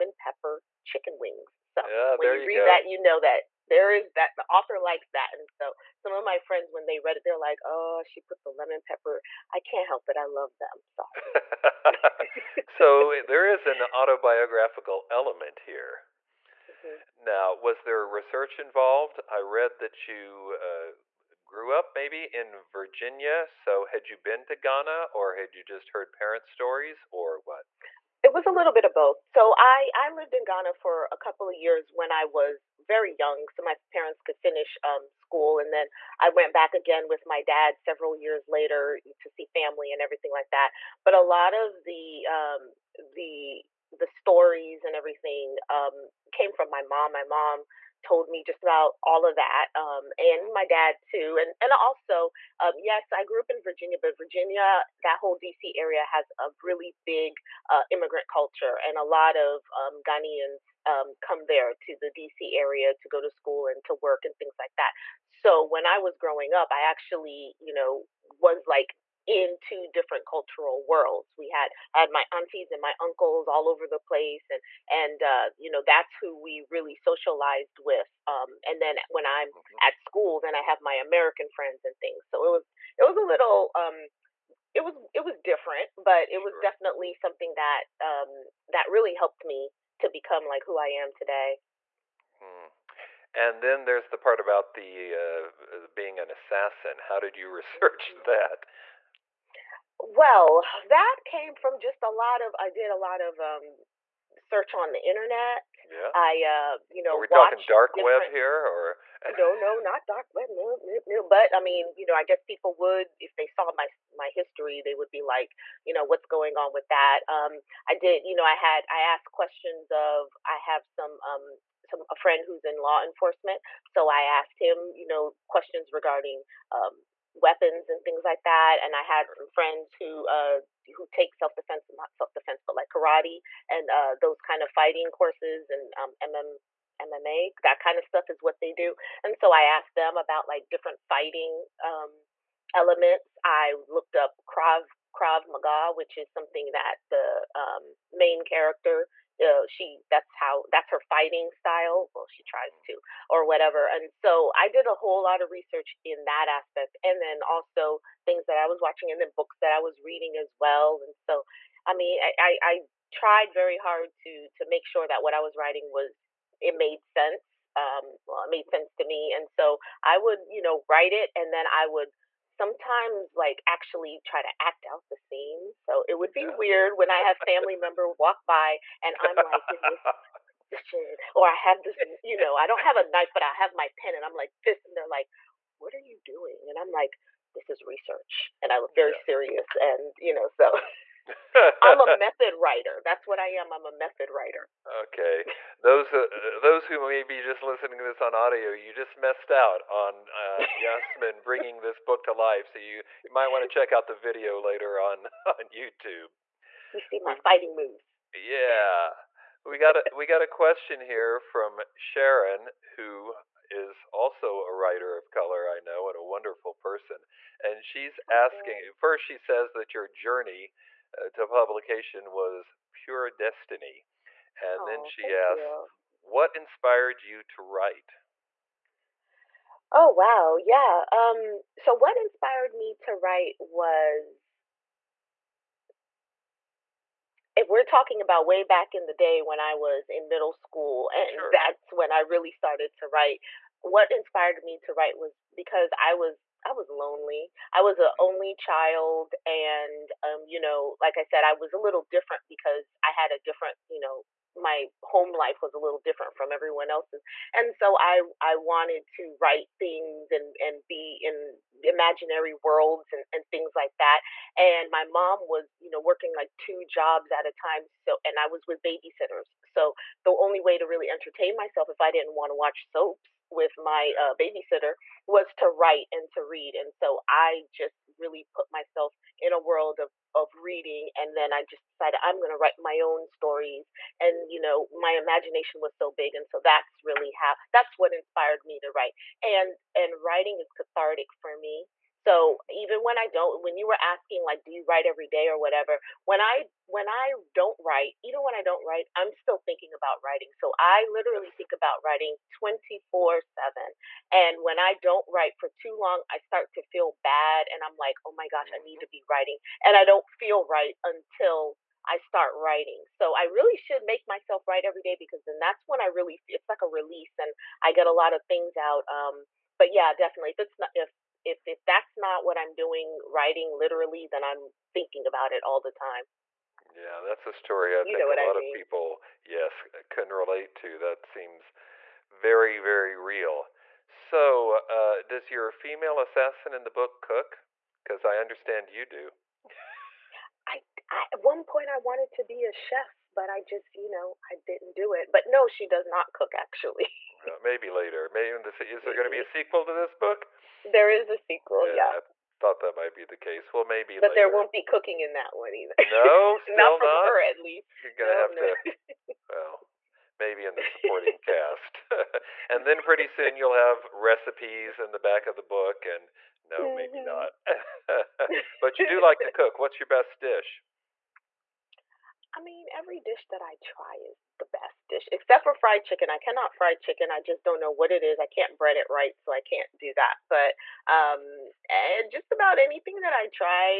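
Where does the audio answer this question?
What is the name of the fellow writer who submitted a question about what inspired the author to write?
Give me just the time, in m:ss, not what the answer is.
3:31.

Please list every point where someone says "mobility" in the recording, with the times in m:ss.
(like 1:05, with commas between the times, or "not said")
not said.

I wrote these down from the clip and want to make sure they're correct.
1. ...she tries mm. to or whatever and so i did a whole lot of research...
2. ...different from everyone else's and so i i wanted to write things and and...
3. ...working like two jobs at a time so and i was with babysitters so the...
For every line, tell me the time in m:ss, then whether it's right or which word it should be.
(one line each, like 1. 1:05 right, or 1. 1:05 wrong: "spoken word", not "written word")
1. 2:32 right
2. 4:15 right
3. 4:25 right.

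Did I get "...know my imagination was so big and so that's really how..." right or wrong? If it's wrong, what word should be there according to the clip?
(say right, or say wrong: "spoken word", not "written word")
right.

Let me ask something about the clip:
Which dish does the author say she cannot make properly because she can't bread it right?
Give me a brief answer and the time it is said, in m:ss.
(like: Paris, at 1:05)
Fried chicken, at 6:15.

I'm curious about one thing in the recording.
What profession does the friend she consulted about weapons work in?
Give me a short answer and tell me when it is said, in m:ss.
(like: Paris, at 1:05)
Law enforcement, at 2:02.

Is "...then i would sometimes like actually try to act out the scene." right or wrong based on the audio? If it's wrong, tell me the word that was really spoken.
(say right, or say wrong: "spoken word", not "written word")
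right.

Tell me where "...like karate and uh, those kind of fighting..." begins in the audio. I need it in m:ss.
2:12.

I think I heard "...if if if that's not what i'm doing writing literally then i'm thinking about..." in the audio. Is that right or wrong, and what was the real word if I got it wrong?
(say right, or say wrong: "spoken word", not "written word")
right.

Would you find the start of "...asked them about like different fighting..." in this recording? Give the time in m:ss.
2:19.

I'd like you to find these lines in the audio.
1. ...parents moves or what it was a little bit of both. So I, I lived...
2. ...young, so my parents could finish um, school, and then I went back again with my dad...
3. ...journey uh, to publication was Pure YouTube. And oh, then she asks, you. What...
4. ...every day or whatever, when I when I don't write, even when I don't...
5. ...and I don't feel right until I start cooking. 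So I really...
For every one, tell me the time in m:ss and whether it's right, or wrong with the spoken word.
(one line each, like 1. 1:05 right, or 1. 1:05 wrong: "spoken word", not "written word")
1. 0:26 wrong: "stories", not "moves"
2. 0:33 right
3. 3:40 wrong: "Destiny", not "YouTube"
4. 4:55 right
5. 5:09 wrong: "writing", not "cooking".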